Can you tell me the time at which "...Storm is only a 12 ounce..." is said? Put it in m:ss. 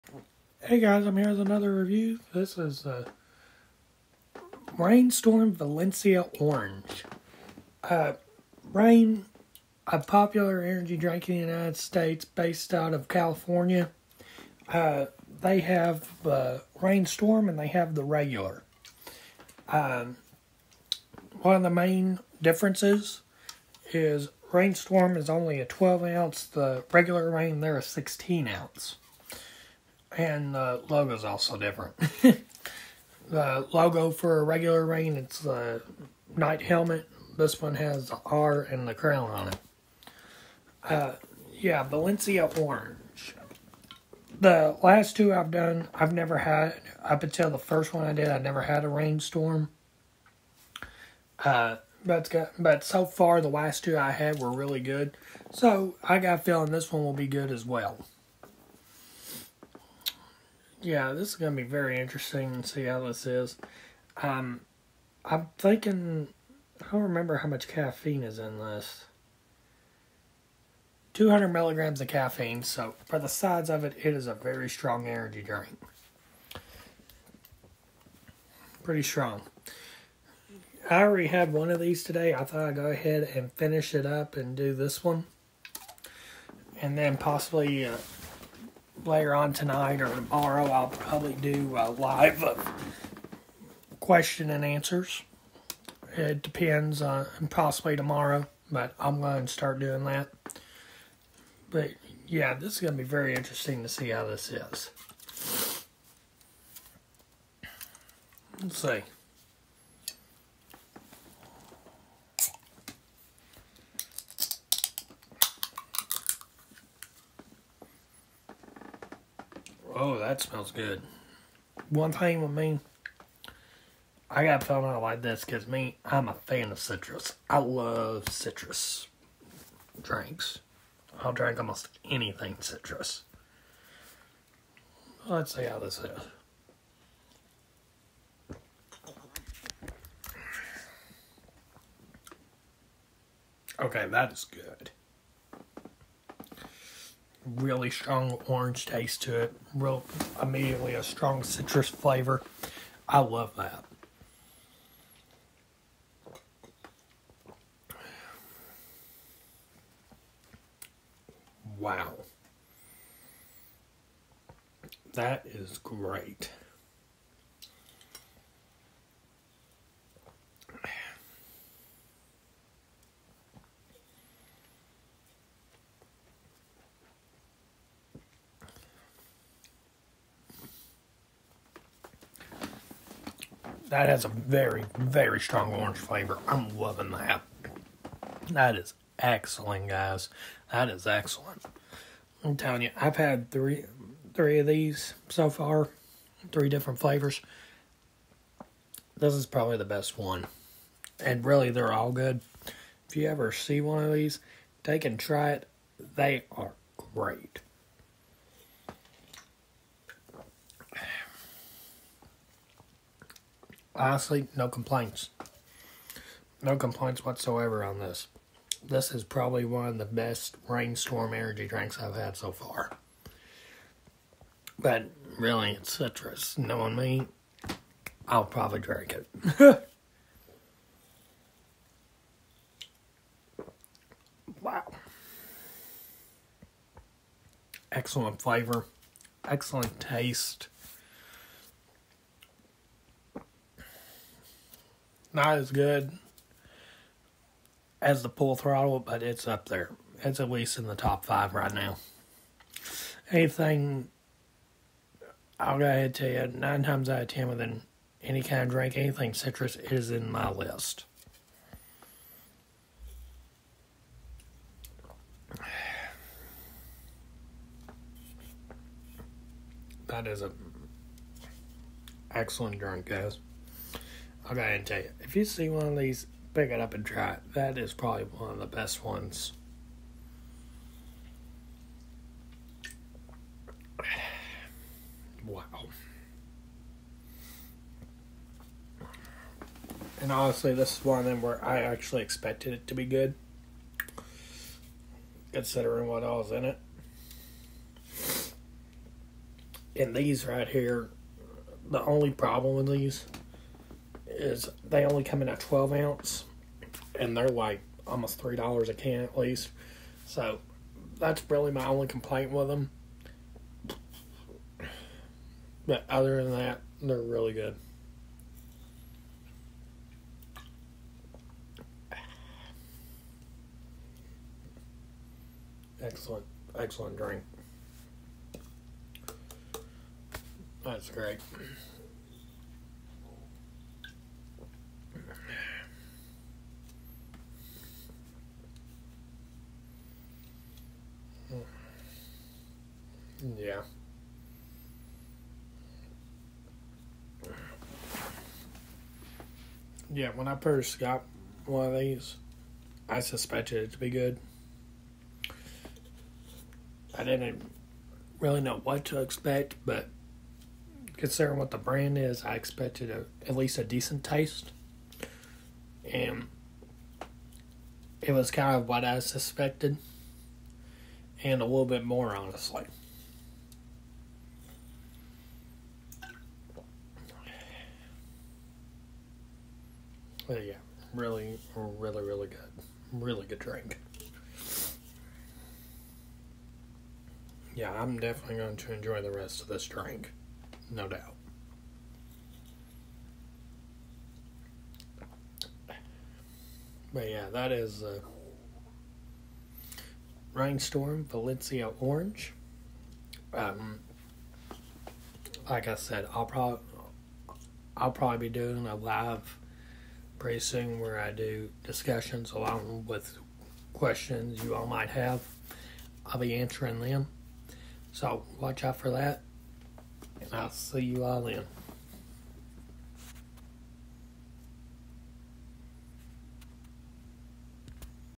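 0:24.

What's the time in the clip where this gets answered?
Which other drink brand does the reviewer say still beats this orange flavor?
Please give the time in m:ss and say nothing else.
4:08.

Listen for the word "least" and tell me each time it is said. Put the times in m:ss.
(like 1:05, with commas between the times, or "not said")
4:10, 5:09, 6:03.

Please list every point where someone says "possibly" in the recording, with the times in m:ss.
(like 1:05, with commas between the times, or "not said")
1:27, 1:37.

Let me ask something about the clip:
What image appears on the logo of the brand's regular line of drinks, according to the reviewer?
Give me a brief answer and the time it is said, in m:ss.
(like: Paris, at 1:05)
knight helmet, at 0:36.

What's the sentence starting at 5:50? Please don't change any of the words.
Yeah, when I first got one of these, I suspected it to be good.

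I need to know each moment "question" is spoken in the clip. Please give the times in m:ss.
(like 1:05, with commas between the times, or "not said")
1:33, 6:53.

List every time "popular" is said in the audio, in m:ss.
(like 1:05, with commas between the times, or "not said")
0:09.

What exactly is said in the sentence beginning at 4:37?
That is probably one of the best ones.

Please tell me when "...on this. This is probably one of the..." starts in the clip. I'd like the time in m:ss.
3:37.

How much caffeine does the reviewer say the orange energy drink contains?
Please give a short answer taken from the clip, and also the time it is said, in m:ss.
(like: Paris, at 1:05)
200 milligrams, at 1:11.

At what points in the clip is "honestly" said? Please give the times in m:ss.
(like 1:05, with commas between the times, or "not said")
3:34, 4:50, 6:12.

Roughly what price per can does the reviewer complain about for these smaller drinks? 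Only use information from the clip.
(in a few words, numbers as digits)
almost $3.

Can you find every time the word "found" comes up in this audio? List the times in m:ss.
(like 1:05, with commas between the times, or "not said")
2:04.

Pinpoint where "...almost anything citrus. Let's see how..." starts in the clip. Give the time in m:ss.
2:11.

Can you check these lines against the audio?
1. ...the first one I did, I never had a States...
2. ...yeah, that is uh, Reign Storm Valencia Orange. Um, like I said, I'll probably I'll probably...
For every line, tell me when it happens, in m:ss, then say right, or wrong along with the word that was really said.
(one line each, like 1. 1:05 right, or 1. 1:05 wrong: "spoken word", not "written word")
1. 0:47 wrong: "Reign", not "States"
2. 6:37 right.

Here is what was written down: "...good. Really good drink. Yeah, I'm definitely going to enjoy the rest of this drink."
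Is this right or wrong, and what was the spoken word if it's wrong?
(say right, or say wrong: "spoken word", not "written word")
right.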